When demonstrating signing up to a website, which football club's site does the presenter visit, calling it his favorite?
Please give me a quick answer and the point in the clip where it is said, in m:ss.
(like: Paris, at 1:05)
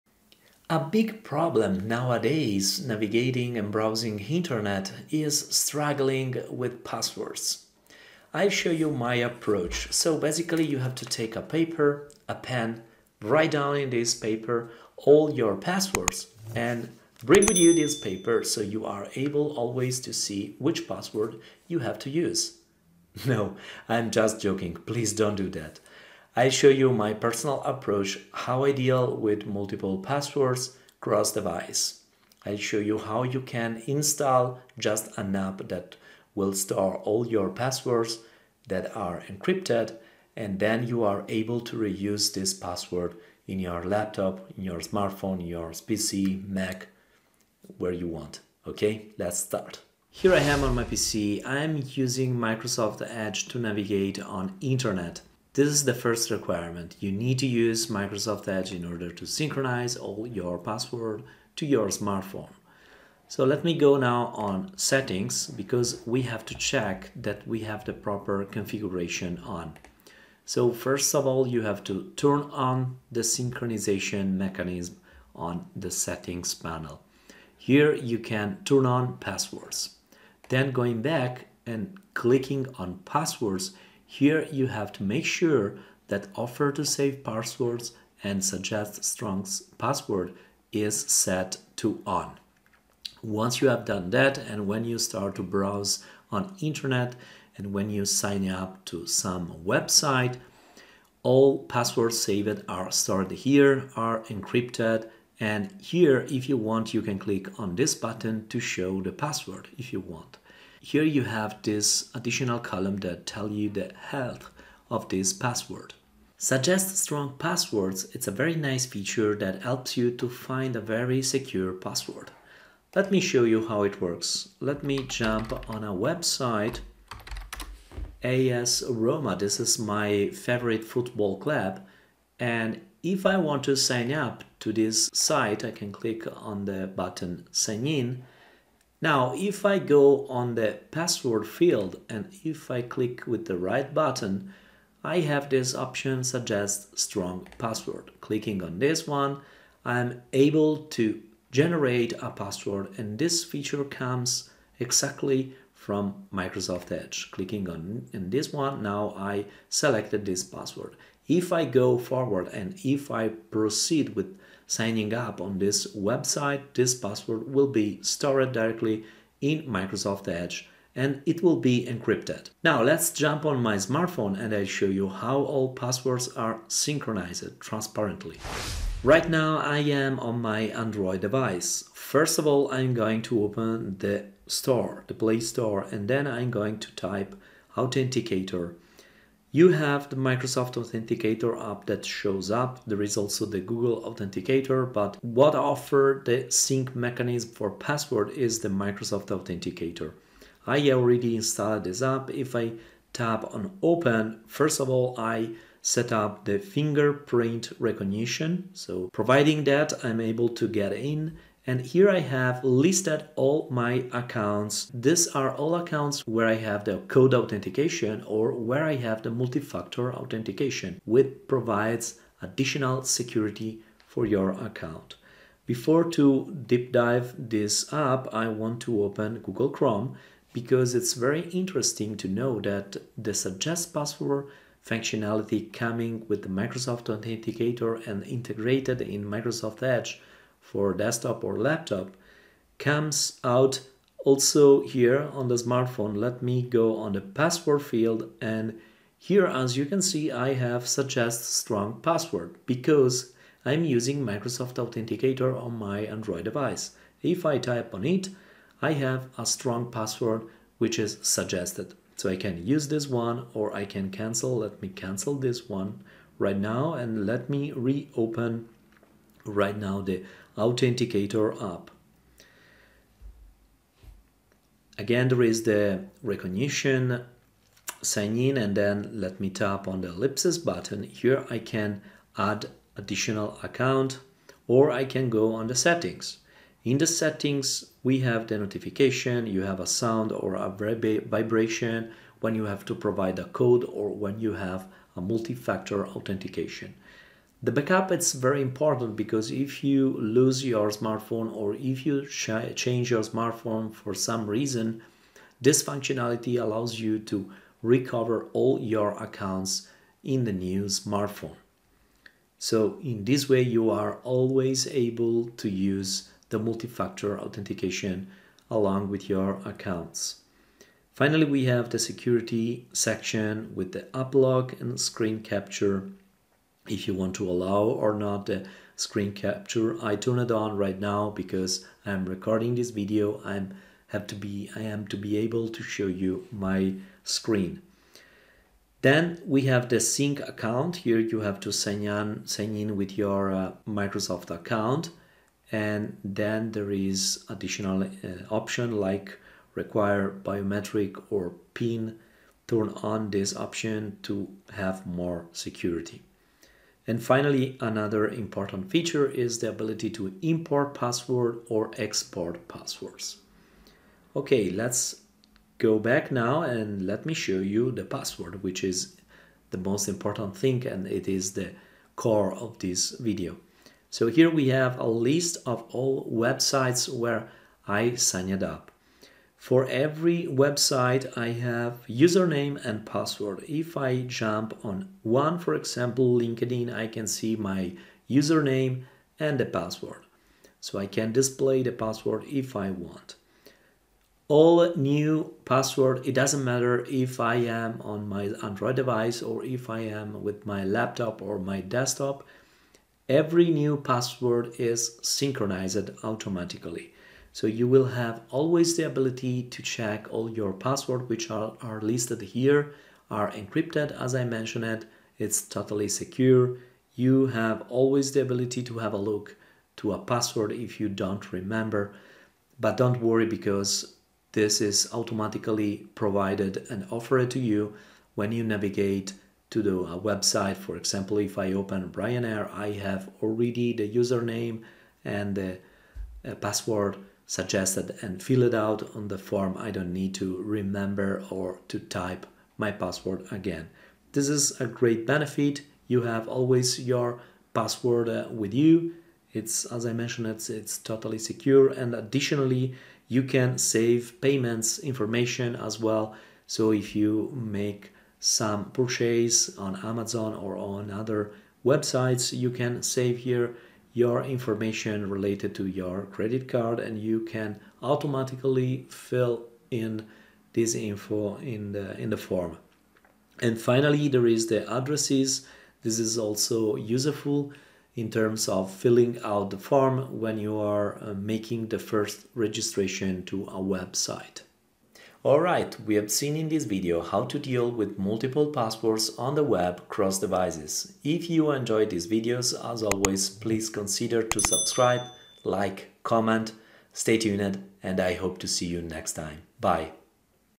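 AS Roma, at 2:08.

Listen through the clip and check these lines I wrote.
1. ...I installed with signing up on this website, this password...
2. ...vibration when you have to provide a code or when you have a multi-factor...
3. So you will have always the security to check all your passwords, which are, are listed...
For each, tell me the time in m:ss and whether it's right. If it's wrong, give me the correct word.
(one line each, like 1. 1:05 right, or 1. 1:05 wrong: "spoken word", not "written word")
1. 2:43 wrong: "proceed", not "installed"
2. 4:50 right
3. 6:47 wrong: "ability", not "security".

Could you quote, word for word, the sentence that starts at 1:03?
So let me go now on settings because we have to check that we have the proper configuration on.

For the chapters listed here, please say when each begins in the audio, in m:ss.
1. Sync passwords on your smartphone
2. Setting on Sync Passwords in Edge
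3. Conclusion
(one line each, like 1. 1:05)
1. 2:58
2. 0:50
3. 8:06.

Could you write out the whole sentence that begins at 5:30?
I turn it on right now because I'm recording this video.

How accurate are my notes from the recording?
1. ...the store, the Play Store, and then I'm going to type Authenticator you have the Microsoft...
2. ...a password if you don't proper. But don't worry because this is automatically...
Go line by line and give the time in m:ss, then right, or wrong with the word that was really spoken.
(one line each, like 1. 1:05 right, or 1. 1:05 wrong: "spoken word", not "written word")
1. 3:03 right
2. 7:00 wrong: "remember", not "proper".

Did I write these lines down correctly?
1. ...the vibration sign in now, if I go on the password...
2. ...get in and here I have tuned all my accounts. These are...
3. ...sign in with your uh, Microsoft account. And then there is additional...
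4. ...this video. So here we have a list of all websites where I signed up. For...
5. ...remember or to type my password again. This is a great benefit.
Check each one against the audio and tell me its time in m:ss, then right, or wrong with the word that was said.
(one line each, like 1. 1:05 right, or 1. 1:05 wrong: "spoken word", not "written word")
1. 2:16 wrong: "button", not "vibration"
2. 3:30 wrong: "listed", not "tuned"
3. 5:42 right
4. 6:12 right
5. 7:20 right.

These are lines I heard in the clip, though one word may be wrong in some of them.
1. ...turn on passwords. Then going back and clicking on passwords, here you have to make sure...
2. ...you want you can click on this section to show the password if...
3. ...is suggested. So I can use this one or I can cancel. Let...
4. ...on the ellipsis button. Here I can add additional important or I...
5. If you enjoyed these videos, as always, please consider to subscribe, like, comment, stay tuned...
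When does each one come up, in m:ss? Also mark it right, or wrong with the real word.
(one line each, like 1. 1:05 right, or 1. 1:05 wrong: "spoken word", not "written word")
1. 1:18 right
2. 1:46 wrong: "button", not "section"
3. 4:20 right
4. 4:39 wrong: "account", not "important"
5. 8:11 right.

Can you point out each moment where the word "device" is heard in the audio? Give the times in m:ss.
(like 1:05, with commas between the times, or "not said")
0:31, 3:01, 4:16, 6:38, 8:10.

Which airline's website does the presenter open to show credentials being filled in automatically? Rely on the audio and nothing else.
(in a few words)
Ryanair.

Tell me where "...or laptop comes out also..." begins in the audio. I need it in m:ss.
4:01.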